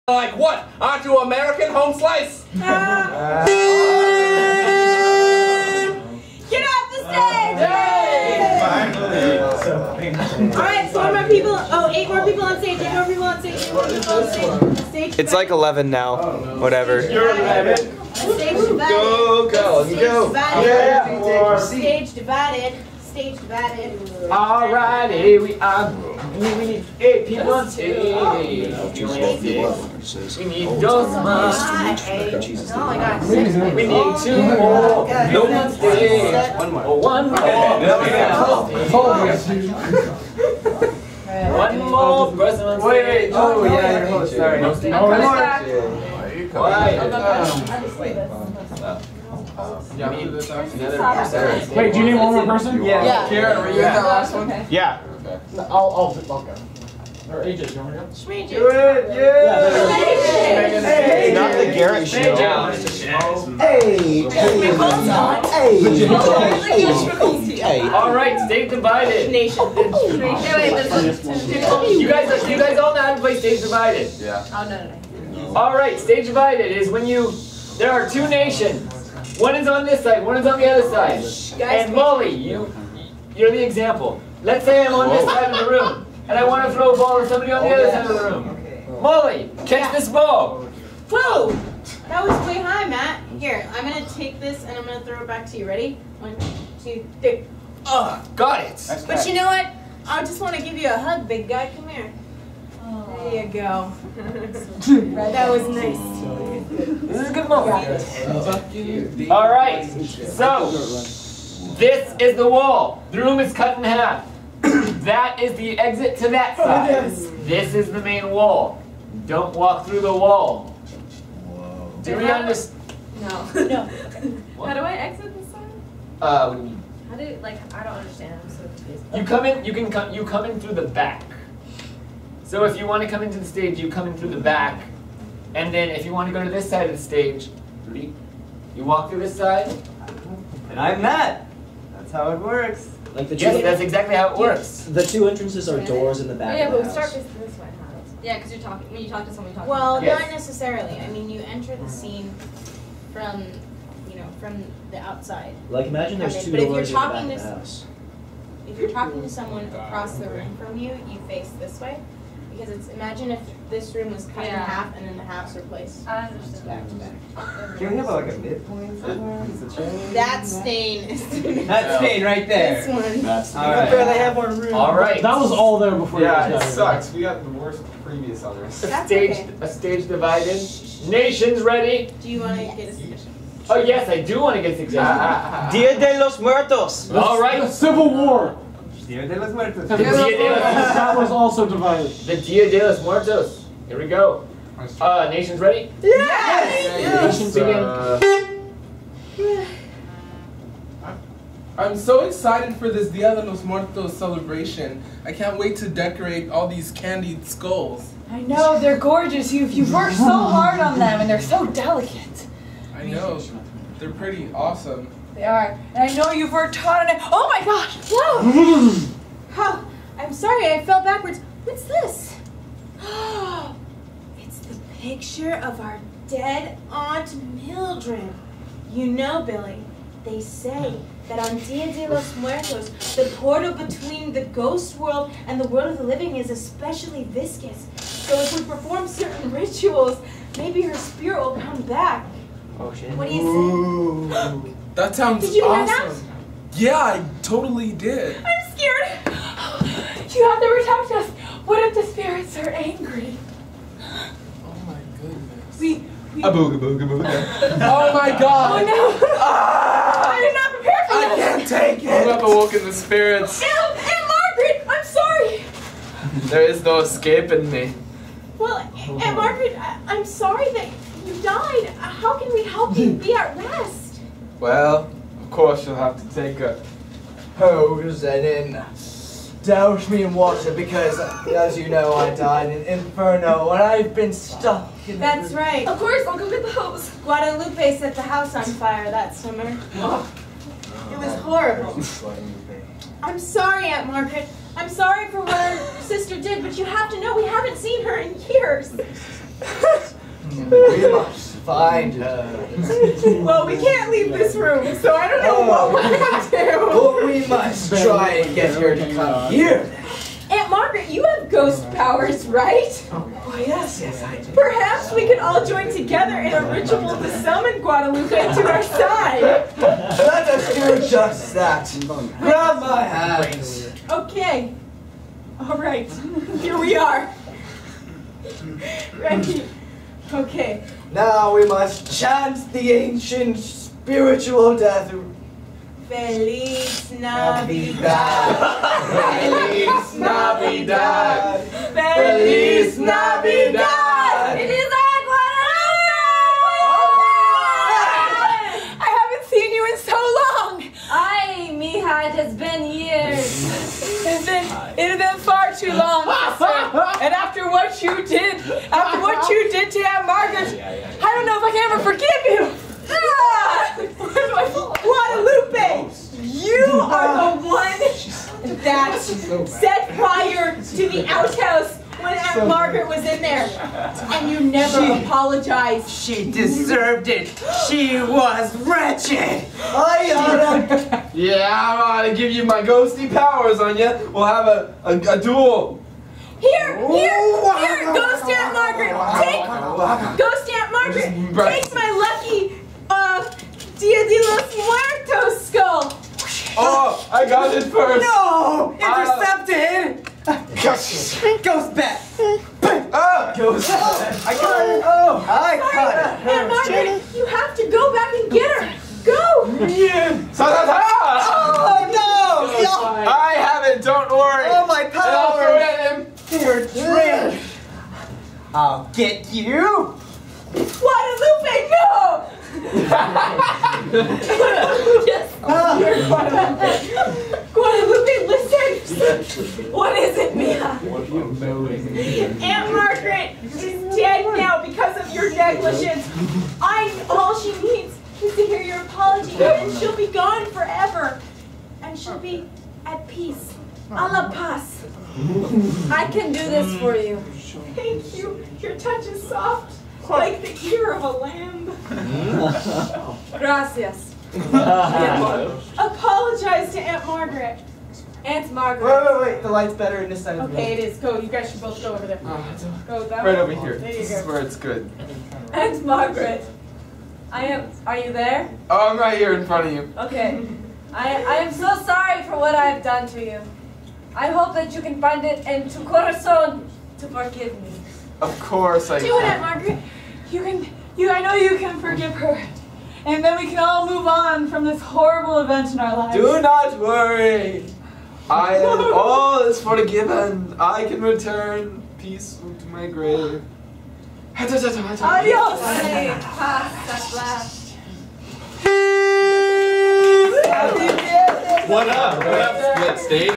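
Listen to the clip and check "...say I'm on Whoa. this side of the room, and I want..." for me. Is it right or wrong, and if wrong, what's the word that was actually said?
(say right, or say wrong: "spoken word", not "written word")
right.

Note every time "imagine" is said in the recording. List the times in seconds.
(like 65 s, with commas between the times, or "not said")
155 s, 162 s.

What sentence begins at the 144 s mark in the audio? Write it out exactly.
The two entrances are doors in the back.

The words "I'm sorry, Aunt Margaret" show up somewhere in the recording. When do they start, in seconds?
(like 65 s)
293 s.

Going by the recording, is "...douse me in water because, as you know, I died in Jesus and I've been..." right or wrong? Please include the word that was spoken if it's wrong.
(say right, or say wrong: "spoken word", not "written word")
wrong: "Inferno", not "Jesus".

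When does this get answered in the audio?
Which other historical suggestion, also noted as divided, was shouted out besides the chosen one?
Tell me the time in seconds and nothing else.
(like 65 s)
187 s.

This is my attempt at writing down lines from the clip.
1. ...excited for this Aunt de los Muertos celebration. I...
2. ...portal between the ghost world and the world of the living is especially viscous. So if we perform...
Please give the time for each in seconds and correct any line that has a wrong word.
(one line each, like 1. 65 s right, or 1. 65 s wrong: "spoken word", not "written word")
1. 202 s wrong: "Dia", not "Aunt"
2. 233 s right.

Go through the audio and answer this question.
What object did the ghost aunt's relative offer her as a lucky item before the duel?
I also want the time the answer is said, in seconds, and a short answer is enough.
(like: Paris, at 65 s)
Dia de los Muertos skull, at 393 s.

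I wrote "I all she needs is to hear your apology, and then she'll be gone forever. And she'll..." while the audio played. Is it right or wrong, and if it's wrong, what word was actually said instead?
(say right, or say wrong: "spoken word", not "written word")
right.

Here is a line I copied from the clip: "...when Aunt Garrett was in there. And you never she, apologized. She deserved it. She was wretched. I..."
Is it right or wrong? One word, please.
wrong.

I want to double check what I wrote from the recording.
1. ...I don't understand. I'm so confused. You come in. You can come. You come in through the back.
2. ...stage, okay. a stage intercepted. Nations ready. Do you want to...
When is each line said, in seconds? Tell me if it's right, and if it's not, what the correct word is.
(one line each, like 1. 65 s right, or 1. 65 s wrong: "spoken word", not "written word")
1. 127 s right
2. 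179 s wrong: "divided", not "intercepted".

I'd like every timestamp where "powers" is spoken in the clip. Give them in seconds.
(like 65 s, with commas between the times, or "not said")
311 s, 383 s.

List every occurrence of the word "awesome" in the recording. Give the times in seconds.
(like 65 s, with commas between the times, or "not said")
214 s, 245 s.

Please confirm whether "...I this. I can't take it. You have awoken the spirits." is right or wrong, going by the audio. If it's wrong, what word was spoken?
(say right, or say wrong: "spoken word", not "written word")
right.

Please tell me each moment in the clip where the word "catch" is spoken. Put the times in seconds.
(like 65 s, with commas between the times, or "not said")
89 s.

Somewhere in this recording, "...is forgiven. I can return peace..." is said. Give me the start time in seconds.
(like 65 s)
489 s.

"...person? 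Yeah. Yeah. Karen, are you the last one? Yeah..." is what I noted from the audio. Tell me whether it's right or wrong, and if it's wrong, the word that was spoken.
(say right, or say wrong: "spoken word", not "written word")
right.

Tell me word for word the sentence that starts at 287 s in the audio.
Guadalupe set the house on fire that summer.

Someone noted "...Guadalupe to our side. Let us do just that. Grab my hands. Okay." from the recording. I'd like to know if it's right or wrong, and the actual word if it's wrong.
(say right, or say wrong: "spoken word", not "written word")
right.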